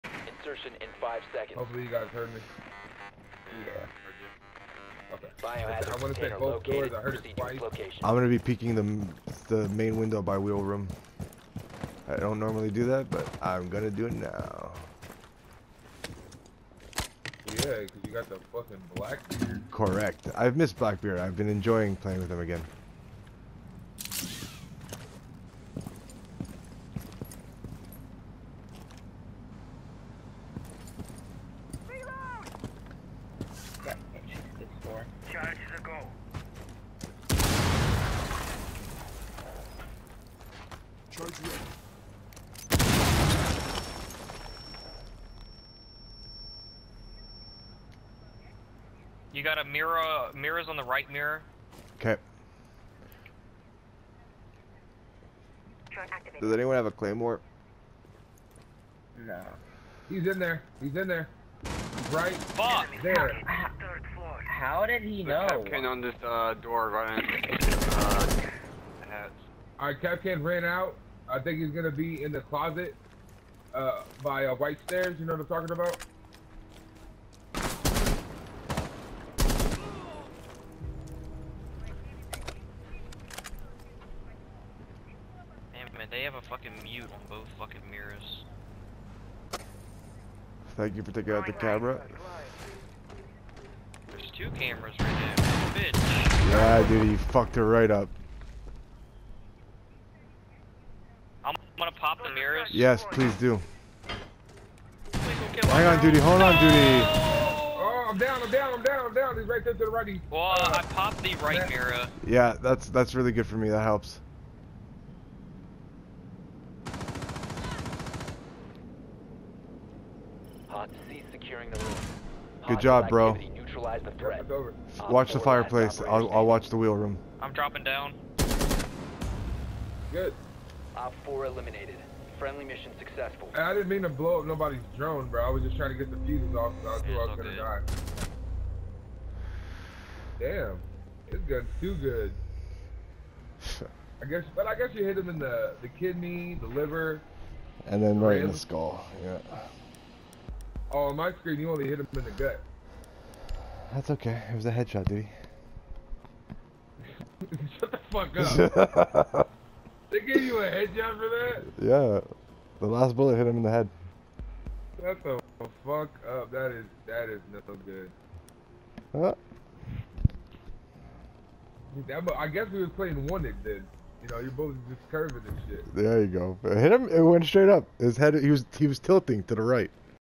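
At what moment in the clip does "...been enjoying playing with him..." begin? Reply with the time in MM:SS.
00:21.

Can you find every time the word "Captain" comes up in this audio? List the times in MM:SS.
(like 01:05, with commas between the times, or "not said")
01:05, 01:09.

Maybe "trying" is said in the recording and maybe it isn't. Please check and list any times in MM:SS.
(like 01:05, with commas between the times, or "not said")
02:15.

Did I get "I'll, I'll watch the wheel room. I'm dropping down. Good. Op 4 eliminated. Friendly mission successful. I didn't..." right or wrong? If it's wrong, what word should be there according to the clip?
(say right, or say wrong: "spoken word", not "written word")
right.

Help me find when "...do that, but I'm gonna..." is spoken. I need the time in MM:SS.
00:12.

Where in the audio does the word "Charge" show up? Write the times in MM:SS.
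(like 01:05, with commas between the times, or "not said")
00:35, 00:41.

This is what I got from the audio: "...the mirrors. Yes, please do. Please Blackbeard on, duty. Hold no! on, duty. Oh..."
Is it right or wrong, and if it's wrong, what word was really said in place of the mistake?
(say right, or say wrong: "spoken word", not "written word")
wrong: "Hang", not "Blackbeard".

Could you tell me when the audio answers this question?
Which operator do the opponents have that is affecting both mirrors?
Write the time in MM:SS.
01:26.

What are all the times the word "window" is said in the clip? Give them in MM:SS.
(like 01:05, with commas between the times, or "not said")
00:09.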